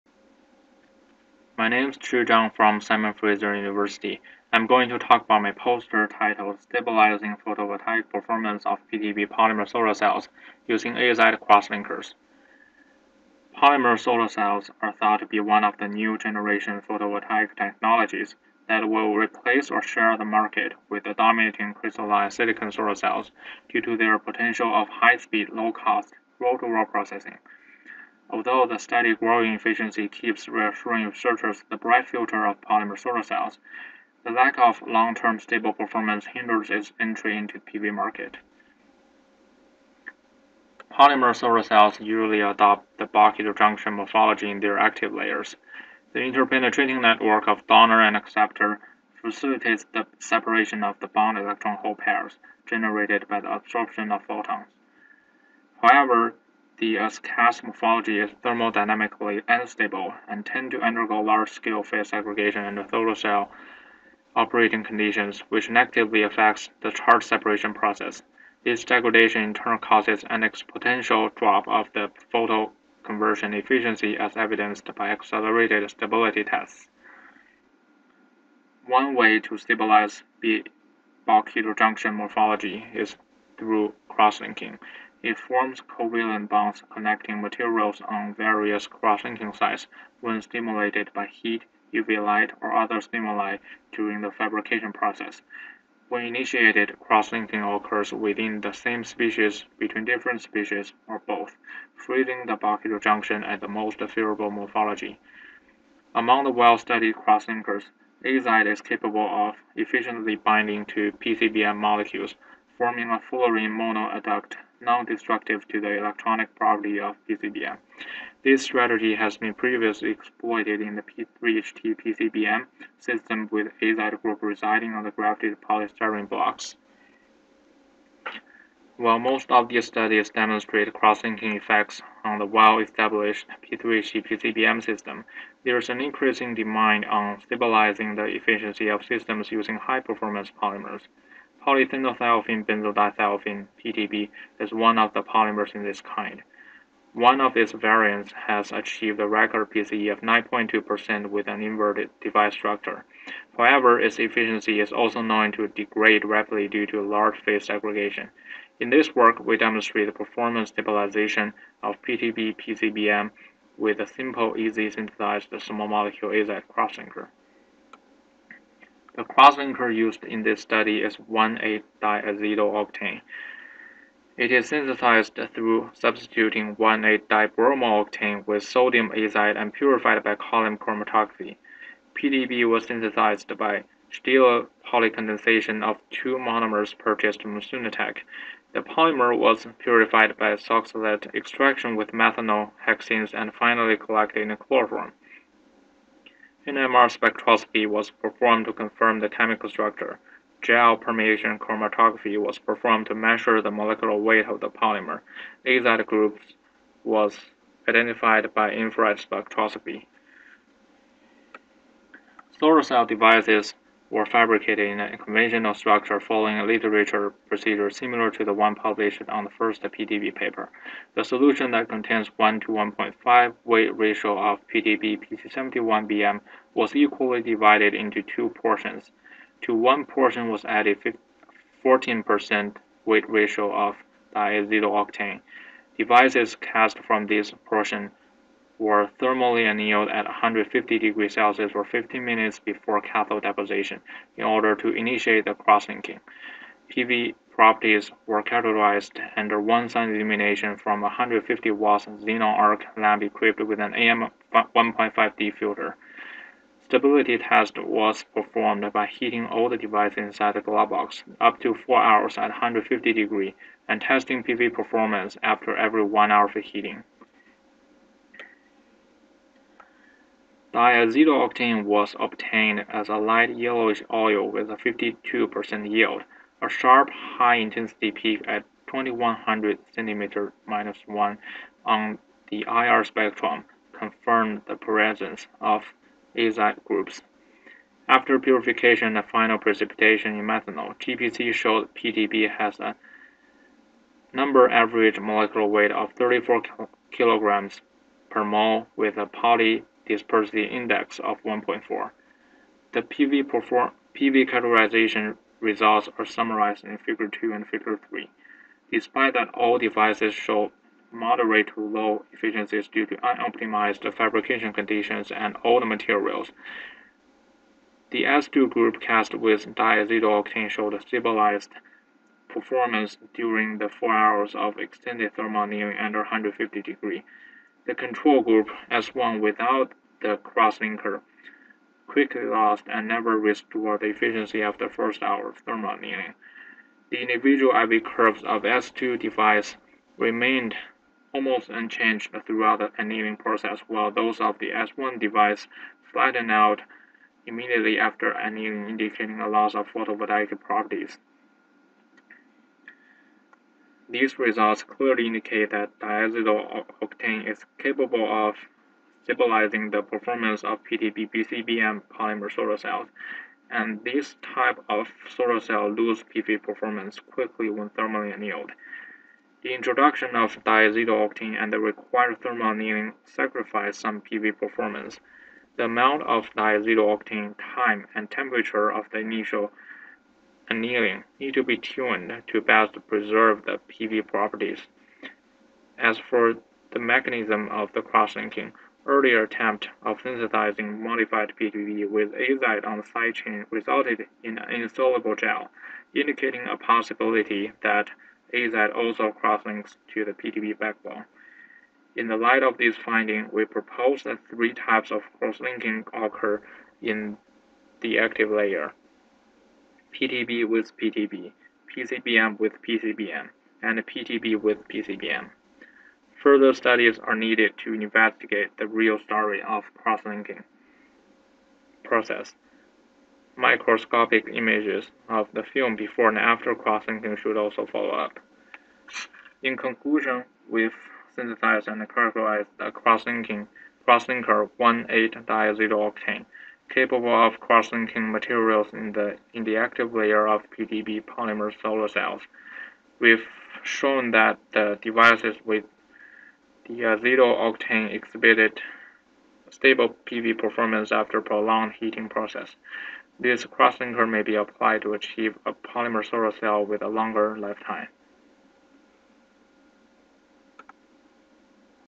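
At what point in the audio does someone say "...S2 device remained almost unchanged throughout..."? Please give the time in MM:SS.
05:38.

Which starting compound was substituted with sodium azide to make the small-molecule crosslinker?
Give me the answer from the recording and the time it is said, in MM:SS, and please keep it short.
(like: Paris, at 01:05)
1,8-dibromo-octane, at 02:56.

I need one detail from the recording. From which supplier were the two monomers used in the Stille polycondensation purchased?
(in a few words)
SunaTech.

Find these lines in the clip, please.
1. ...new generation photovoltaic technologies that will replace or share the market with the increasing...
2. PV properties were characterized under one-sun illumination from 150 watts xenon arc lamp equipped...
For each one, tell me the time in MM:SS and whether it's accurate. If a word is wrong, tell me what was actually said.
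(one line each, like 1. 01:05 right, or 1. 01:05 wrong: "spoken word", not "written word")
1. 00:15 wrong: "dominating", not "increasing"
2. 04:06 right.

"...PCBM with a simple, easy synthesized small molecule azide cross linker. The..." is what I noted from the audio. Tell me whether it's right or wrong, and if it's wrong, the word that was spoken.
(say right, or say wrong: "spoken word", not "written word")
right.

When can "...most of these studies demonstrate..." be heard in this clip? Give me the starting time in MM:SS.
02:09.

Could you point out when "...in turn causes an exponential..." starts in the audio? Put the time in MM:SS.
01:09.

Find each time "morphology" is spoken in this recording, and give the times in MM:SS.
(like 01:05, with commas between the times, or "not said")
00:43, 00:57, 01:22, 01:44.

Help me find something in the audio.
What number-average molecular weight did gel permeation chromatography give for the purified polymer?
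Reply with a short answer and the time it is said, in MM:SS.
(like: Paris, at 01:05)
34 kg/mol, at 04:56.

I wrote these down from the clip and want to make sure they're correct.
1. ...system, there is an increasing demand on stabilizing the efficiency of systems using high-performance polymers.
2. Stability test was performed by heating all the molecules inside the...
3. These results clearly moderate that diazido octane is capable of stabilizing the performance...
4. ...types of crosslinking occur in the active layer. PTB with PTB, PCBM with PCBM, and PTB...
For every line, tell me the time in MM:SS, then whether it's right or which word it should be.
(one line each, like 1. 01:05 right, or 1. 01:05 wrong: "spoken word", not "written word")
1. 02:14 right
2. 04:16 wrong: "devices", not "molecules"
3. 05:54 wrong: "indicate", not "moderate"
4. 06:44 right.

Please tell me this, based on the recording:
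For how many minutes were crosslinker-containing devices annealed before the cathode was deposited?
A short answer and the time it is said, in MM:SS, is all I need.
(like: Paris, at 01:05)
15 minutes, at 04:01.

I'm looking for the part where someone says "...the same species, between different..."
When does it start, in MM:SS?
01:38.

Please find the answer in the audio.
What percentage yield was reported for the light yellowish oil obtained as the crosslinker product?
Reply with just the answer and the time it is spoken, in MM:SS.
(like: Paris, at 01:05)
52%, at 04:34.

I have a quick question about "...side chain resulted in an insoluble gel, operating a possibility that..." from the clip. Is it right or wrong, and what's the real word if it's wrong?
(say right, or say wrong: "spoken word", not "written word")
wrong: "indicating", not "operating".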